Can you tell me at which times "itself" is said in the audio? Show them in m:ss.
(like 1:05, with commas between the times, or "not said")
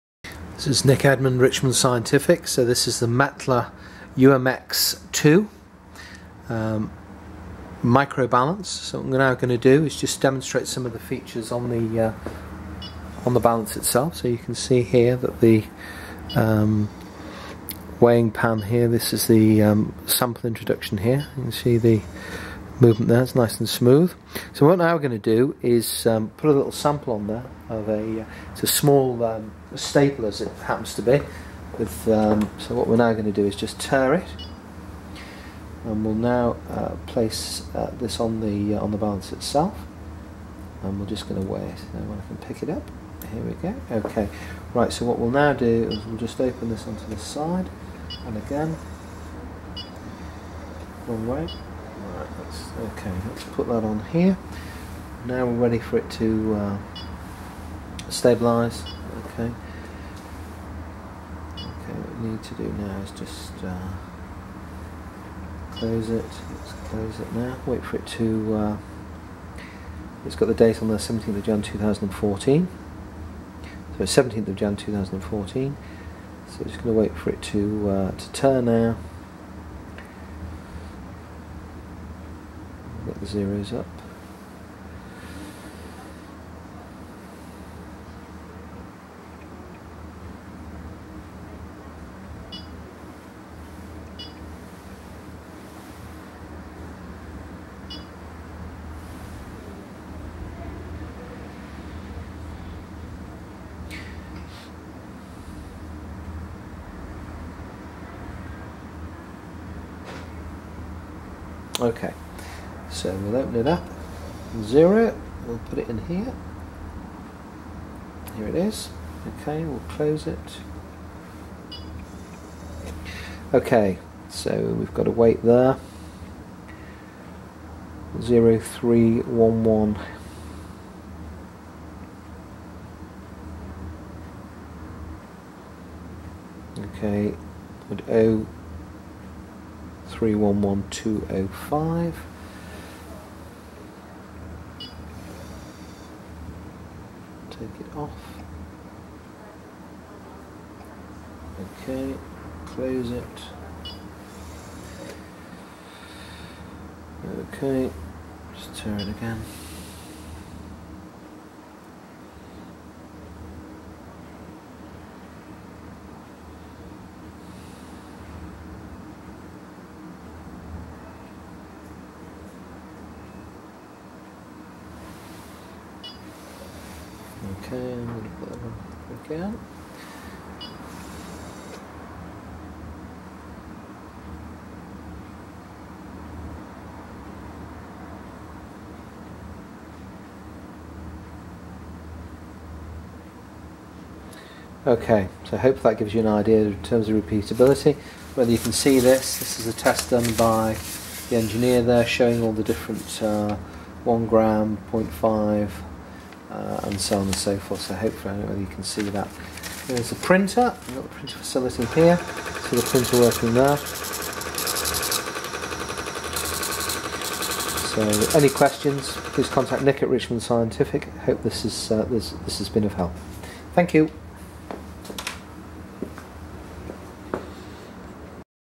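0:13, 0:39.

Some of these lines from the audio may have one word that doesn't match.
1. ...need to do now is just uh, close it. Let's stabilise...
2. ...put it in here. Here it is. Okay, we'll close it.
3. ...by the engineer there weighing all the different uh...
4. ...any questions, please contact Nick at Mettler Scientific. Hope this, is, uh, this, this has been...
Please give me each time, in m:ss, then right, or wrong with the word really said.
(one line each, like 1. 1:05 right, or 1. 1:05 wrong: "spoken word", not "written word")
1. 1:02 wrong: "close", not "stabilise"
2. 1:55 right
3. 3:20 wrong: "showing", not "weighing"
4. 3:38 wrong: "Richmond", not "Mettler".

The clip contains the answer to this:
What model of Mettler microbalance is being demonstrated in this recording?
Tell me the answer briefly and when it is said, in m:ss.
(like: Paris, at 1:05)
UMX2, at 0:04.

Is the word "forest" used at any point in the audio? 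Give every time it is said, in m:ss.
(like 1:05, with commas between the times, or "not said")
not said.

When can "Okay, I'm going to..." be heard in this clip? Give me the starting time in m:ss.
2:57.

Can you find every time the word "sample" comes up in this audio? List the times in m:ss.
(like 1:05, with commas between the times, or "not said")
0:20, 0:26.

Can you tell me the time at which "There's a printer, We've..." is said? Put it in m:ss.
3:29.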